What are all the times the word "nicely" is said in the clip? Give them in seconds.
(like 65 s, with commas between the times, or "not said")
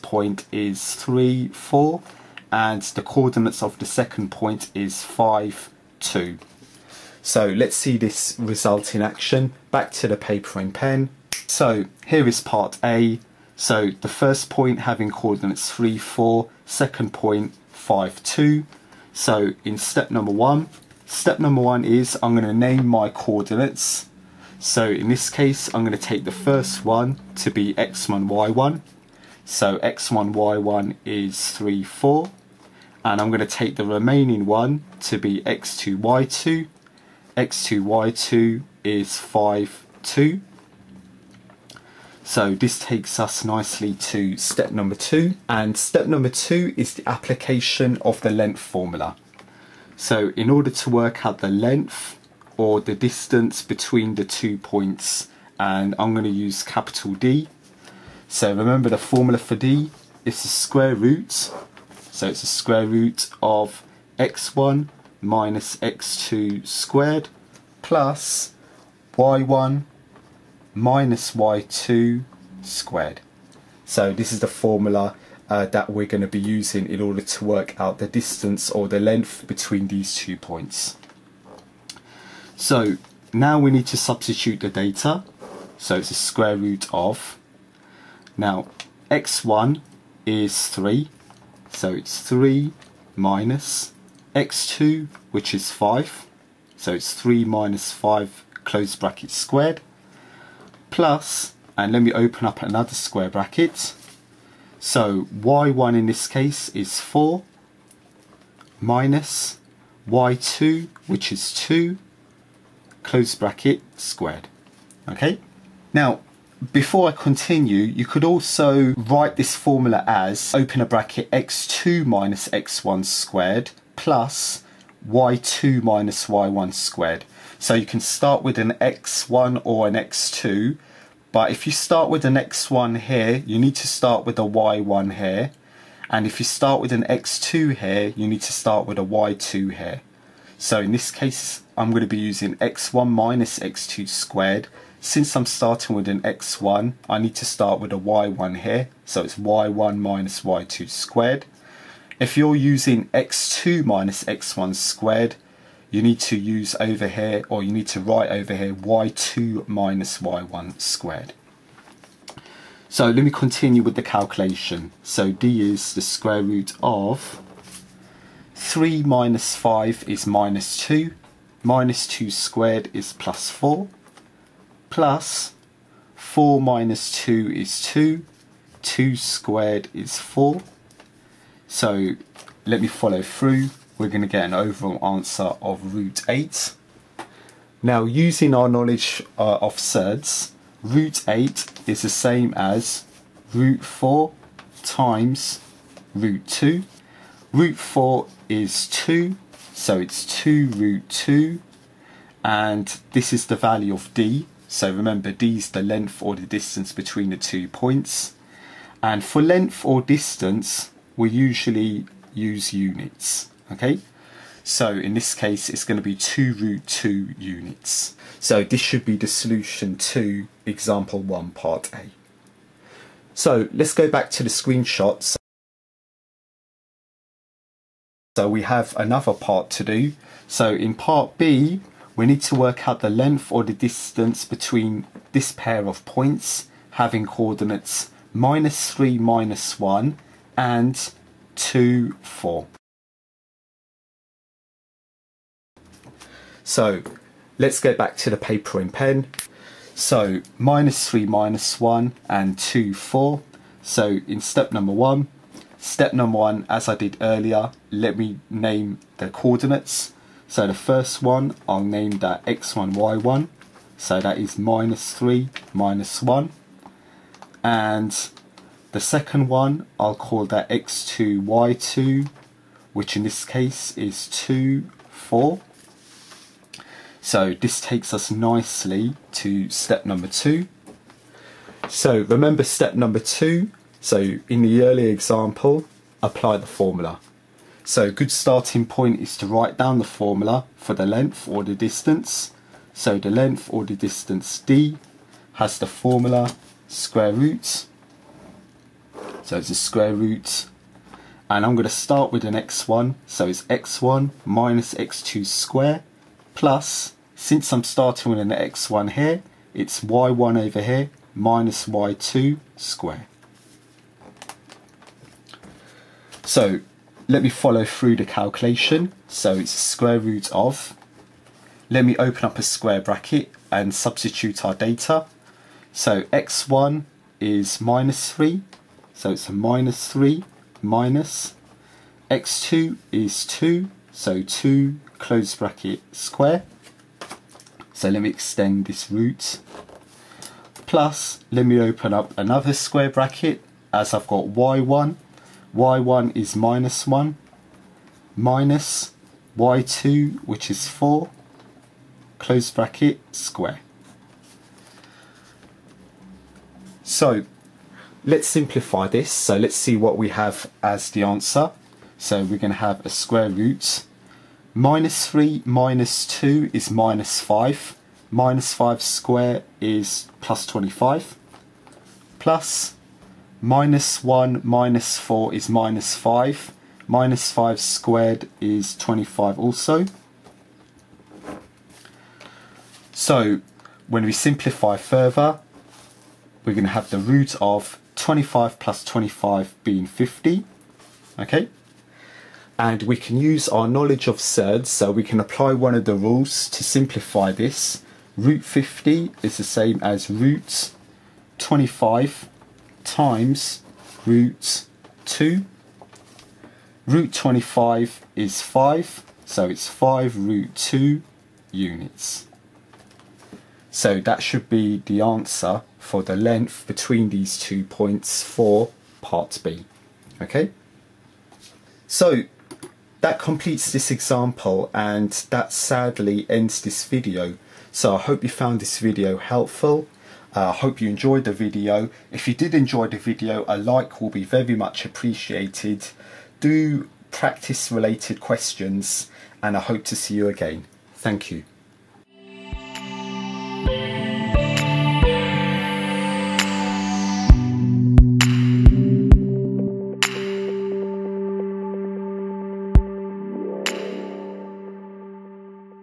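43 s, 278 s.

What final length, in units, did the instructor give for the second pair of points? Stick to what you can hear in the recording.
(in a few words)
5 root 2 units.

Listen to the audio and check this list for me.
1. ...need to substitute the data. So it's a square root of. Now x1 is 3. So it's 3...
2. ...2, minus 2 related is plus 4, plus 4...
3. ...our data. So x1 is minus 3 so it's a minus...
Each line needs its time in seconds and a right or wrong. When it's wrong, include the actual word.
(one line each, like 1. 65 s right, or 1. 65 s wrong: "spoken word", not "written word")
1. 83 s right
2. 170 s wrong: "squared", not "related"
3. 324 s right.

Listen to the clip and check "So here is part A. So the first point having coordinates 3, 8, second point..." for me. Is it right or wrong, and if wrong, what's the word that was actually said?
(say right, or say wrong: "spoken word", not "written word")
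wrong: "4", not "8".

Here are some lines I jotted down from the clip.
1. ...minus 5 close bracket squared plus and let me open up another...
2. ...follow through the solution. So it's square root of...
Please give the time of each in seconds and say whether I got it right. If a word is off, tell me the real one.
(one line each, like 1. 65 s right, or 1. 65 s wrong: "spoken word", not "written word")
1. 97 s right
2. 317 s wrong: "calculation", not "solution".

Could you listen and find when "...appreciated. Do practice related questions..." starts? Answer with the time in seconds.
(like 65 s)
435 s.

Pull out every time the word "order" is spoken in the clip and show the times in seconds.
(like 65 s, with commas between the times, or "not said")
50 s, 77 s.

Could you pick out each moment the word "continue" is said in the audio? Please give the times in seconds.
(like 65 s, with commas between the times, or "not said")
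117 s, 163 s.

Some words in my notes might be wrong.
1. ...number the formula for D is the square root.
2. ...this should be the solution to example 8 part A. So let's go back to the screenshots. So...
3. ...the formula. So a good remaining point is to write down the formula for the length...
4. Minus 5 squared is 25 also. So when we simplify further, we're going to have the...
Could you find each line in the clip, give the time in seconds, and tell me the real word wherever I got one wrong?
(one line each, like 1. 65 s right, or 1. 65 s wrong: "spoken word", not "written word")
1. 58 s wrong: "remember", not "number"
2. 218 s wrong: "1", not "8"
3. 286 s wrong: "starting", not "remaining"
4. 377 s right.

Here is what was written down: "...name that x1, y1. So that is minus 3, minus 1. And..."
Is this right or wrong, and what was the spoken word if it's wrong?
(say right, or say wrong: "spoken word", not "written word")
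right.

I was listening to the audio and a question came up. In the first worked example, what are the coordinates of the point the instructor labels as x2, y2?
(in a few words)
5, 2.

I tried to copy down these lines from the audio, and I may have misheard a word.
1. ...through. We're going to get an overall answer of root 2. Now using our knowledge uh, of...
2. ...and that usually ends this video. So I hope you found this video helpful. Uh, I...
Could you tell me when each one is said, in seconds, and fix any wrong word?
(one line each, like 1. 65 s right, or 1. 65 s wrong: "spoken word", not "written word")
1. 183 s wrong: "8", not "2"
2. 424 s wrong: "sadly", not "usually".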